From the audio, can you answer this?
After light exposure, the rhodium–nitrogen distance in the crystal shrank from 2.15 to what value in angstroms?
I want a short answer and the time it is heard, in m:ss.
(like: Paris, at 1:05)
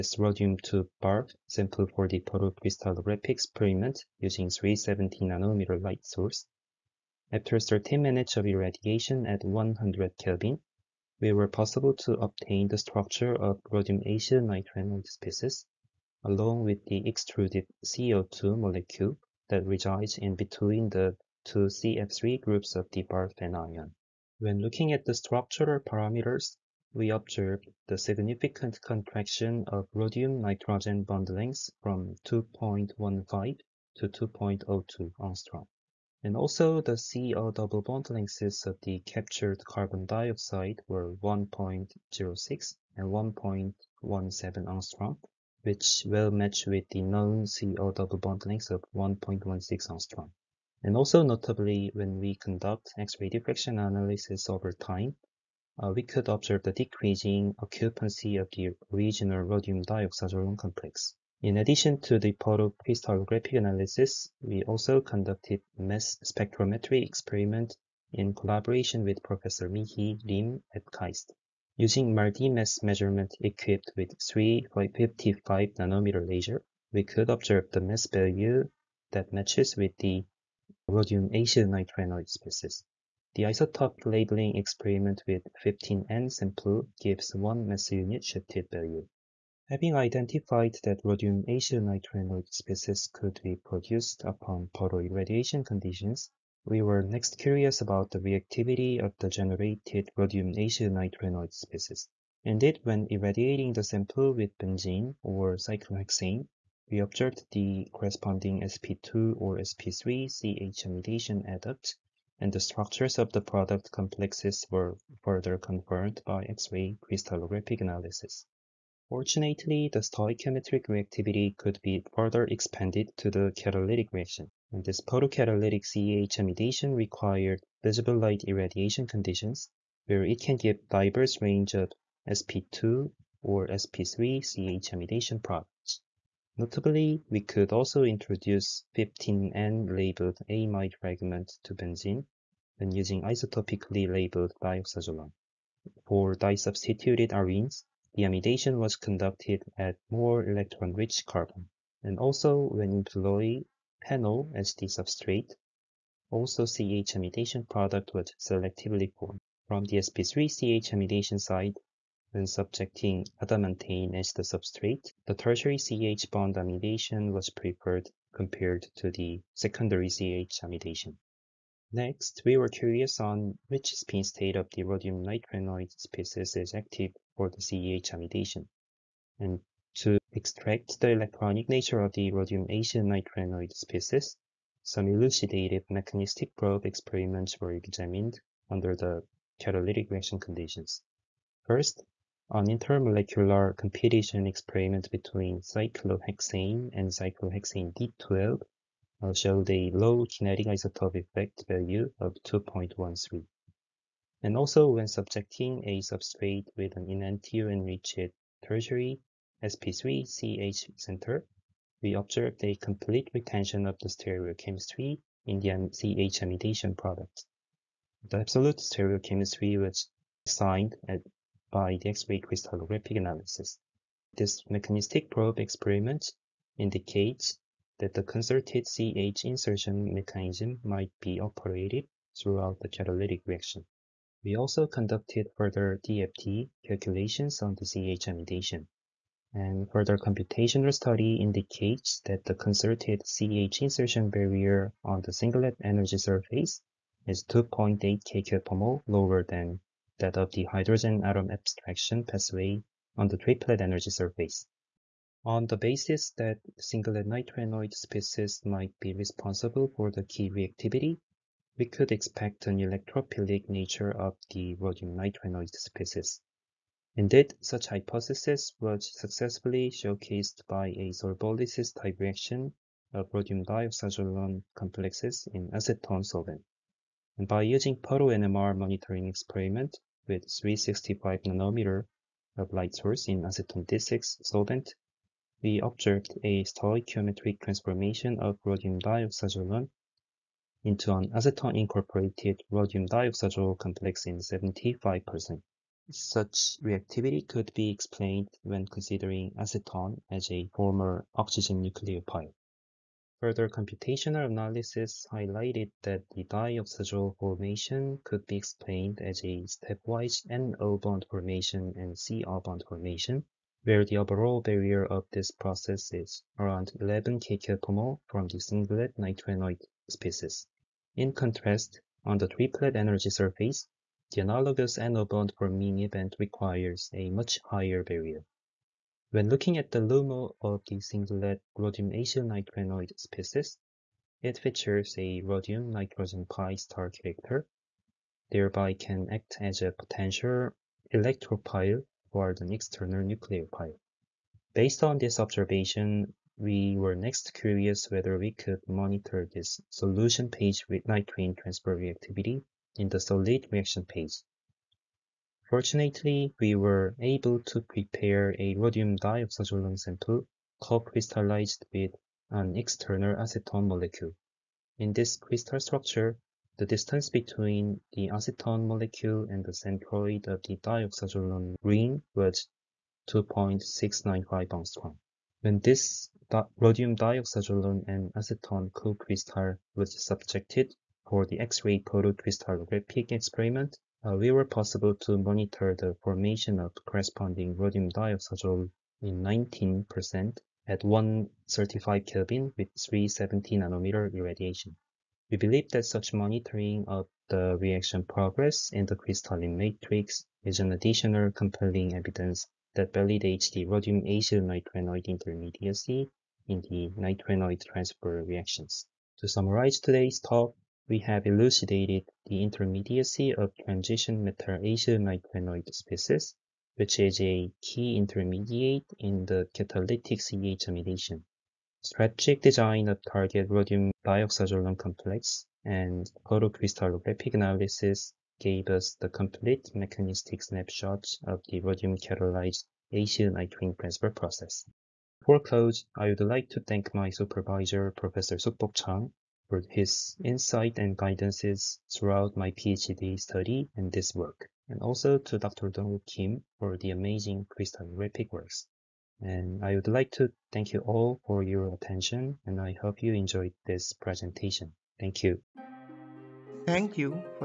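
2.02 angstrom, at 0:34.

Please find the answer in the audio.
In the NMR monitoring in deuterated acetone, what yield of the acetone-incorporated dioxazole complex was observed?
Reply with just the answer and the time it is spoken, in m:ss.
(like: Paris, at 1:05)
75%, at 4:54.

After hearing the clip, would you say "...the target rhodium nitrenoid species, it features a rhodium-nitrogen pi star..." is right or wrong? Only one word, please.
wrong.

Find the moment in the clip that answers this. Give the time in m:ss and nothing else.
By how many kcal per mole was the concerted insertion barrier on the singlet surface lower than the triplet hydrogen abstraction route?
4:07.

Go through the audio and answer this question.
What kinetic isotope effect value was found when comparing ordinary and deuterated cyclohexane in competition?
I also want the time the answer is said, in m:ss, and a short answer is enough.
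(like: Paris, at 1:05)
2.13, at 3:22.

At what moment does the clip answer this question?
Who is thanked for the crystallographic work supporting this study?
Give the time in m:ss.
7:25.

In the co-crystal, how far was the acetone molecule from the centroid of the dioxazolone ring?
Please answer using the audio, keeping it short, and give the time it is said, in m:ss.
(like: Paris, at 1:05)
2.695 angstrom, at 6:13.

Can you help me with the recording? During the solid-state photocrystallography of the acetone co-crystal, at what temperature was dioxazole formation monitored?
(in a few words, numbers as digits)
135 Kelvin.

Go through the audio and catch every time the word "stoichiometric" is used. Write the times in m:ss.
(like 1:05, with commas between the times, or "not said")
1:59, 4:46.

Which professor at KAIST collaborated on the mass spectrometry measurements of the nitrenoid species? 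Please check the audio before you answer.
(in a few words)
Mihi Lim.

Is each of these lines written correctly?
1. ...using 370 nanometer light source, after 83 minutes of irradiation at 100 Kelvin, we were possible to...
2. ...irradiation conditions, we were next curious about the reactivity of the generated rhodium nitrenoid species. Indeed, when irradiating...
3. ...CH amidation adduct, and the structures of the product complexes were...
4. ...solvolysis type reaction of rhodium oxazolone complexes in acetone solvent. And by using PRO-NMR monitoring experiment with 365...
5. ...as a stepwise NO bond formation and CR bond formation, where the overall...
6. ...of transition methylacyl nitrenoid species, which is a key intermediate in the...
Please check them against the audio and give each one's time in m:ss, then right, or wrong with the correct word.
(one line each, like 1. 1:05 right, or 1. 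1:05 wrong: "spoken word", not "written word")
1. 0:04 wrong: "13", not "83"
2. 1:34 right
3. 1:50 right
4. 4:31 right
5. 5:09 right
6. 6:53 right.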